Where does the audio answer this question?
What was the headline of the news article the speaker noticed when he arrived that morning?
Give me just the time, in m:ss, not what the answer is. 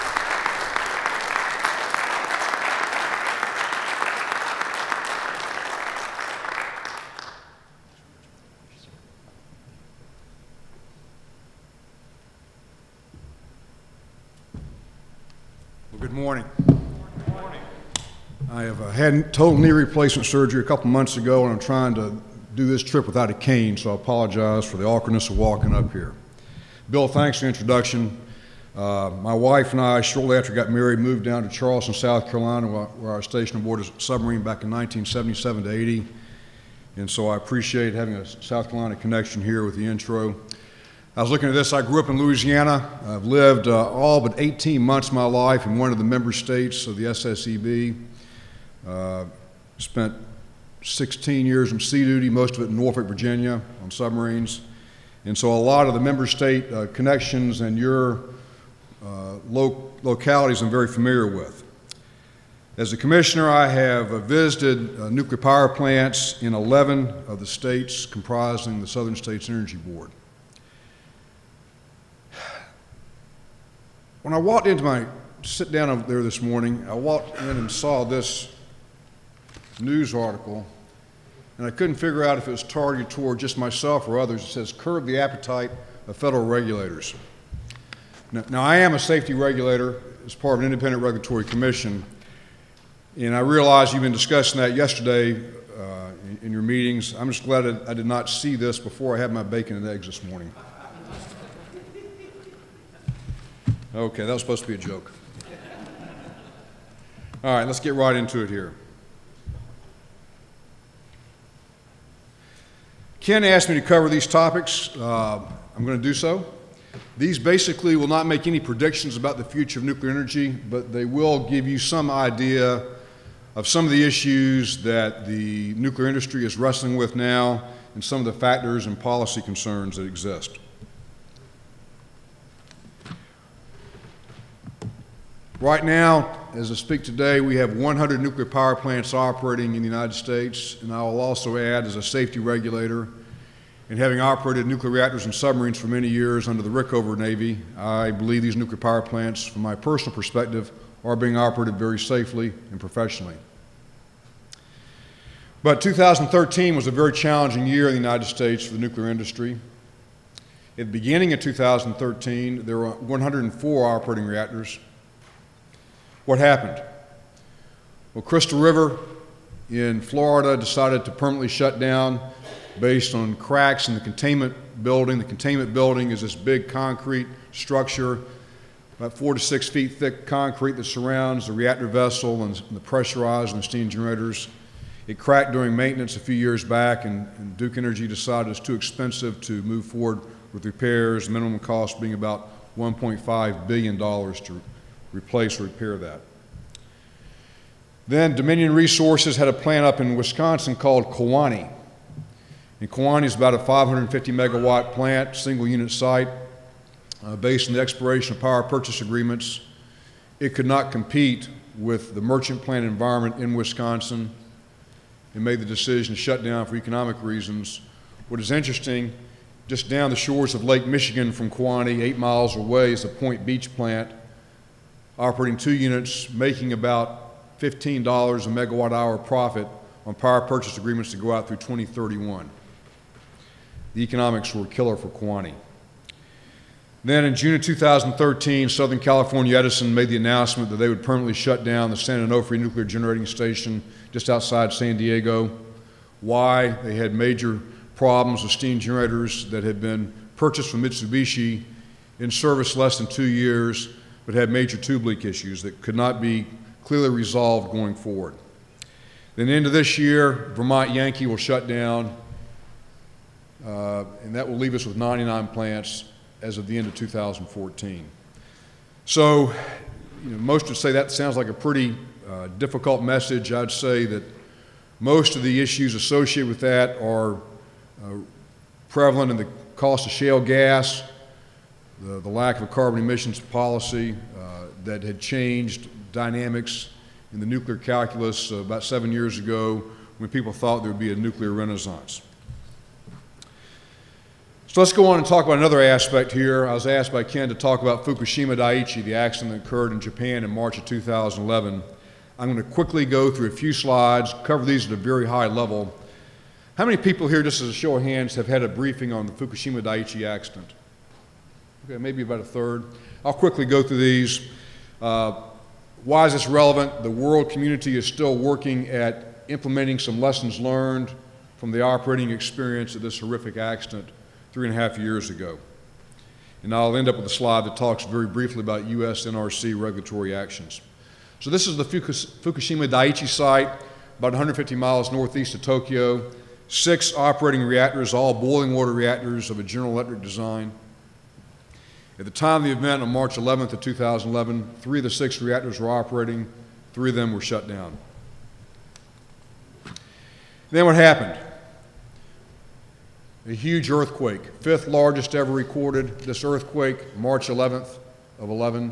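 1:24.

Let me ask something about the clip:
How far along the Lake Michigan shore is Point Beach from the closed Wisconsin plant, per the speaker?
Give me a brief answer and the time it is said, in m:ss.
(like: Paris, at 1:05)
8 miles, at 3:42.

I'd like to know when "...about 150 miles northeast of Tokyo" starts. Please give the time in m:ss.
5:34.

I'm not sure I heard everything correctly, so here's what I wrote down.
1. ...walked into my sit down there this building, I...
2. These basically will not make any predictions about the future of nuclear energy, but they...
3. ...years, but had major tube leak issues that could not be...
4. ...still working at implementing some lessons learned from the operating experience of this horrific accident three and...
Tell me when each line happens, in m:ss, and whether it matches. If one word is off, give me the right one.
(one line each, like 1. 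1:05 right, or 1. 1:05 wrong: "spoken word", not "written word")
1. 1:14 wrong: "morning", not "building"
2. 1:57 right
3. 4:13 right
4. 5:18 right.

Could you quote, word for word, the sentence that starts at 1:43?
Okay, that was supposed to be a joke.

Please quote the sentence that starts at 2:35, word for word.
But 2013 was a very challenging year in the United States for the nuclear industry.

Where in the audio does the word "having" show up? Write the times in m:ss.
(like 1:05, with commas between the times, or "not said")
0:37, 2:23.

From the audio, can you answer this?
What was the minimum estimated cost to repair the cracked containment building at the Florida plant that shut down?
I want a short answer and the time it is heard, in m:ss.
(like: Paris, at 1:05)
$1.5 billion, at 3:12.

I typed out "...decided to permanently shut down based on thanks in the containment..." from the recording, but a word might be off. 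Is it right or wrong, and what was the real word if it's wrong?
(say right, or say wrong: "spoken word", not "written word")
wrong: "cracks", not "thanks".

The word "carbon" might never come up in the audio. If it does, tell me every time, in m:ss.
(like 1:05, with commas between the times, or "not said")
4:42.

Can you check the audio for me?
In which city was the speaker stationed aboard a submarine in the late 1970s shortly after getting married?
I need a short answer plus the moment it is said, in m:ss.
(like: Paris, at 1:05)
Charleston, at 0:31.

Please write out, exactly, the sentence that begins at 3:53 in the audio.
The economics were a killer for Kewaunee.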